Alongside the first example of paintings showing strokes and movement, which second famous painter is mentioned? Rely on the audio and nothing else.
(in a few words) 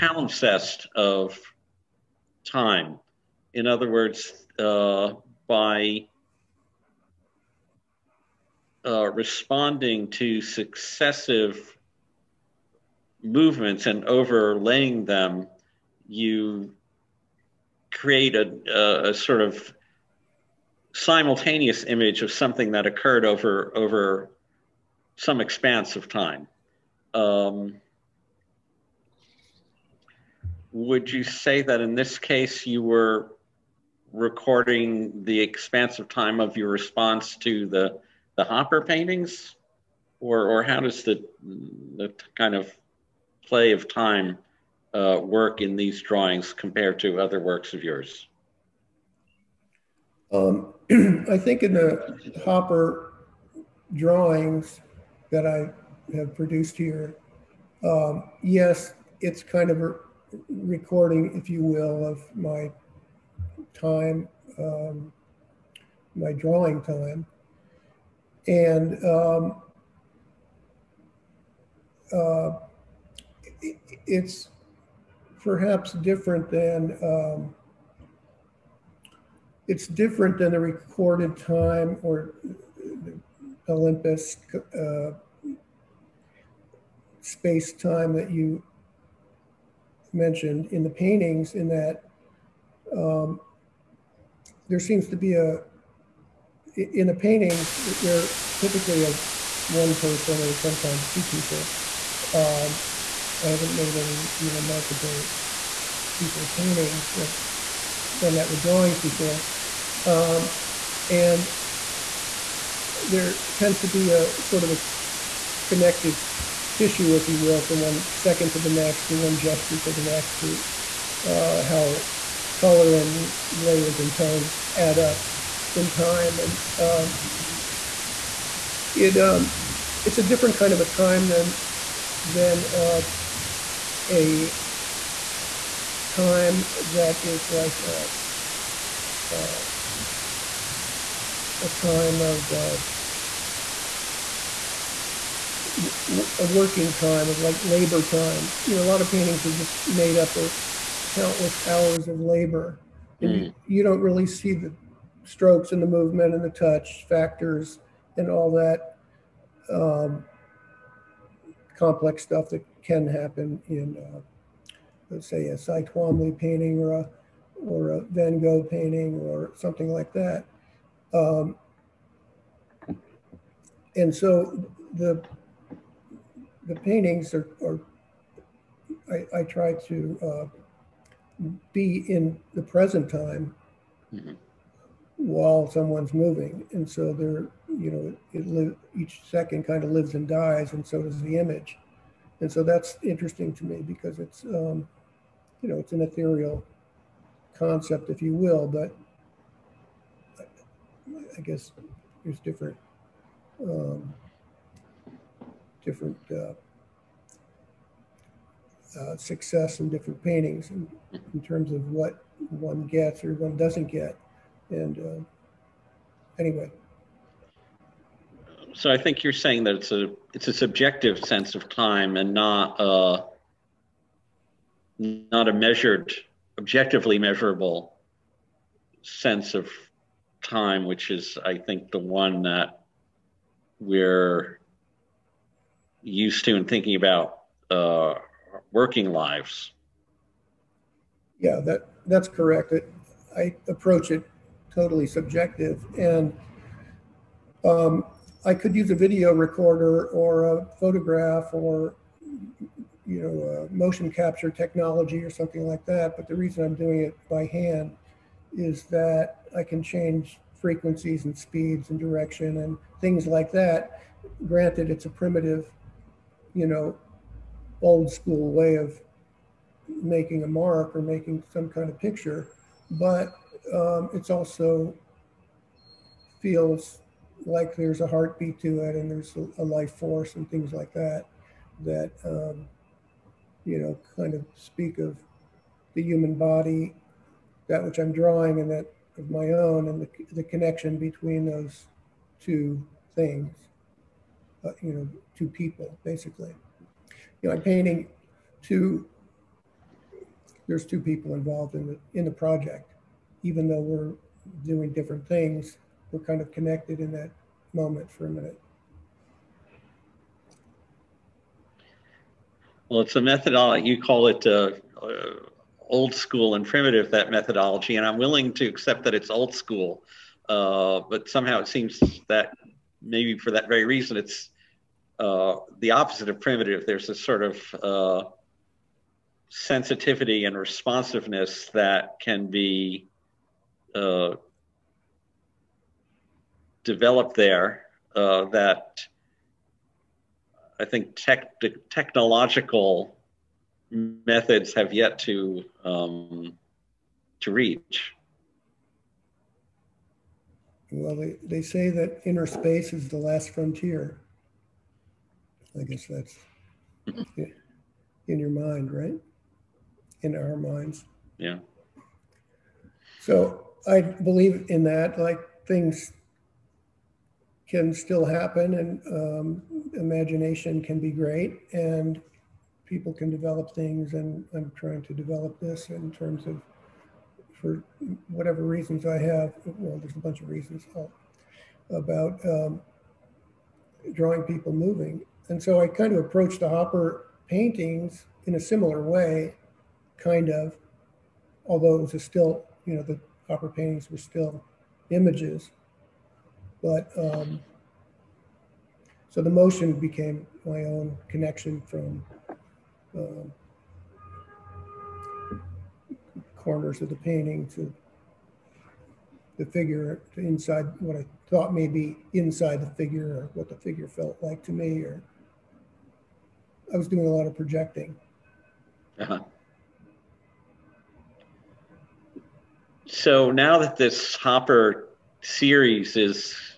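Van Gogh.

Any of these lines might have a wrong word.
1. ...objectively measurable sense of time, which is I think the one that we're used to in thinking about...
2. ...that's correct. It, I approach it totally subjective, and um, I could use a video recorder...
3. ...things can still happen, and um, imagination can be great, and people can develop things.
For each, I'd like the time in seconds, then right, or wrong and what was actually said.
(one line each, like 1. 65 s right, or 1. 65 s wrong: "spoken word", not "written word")
1. 226 s right
2. 242 s right
3. 365 s right.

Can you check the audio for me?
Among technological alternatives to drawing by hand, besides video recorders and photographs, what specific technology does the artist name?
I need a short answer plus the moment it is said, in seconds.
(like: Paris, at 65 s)
motion capture technology, at 253 s.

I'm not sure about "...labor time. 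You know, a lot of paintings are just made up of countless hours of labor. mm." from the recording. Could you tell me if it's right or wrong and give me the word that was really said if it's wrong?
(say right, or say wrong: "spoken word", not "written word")
right.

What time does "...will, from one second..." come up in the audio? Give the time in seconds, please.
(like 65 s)
117 s.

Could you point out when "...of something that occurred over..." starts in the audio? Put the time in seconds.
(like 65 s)
22 s.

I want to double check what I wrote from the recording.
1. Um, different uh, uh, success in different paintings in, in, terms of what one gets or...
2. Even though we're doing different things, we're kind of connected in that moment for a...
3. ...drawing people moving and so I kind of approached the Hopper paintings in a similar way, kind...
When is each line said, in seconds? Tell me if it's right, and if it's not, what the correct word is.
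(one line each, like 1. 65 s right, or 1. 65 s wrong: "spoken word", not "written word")
1. 203 s right
2. 303 s right
3. 384 s right.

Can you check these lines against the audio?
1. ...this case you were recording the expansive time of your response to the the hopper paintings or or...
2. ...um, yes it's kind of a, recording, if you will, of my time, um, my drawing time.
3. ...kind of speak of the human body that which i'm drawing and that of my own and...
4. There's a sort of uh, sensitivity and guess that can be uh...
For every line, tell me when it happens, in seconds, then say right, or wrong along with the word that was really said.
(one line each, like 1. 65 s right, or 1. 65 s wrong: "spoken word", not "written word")
1. 31 s right
2. 57 s right
3. 284 s right
4. 326 s wrong: "responsiveness", not "guess".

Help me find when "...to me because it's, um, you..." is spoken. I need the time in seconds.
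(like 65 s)
193 s.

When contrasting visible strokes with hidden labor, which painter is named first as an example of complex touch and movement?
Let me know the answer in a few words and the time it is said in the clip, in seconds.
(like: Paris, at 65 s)
Cy Twombly, at 165 s.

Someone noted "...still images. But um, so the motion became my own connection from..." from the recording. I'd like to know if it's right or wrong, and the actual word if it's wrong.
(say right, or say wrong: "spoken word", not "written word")
right.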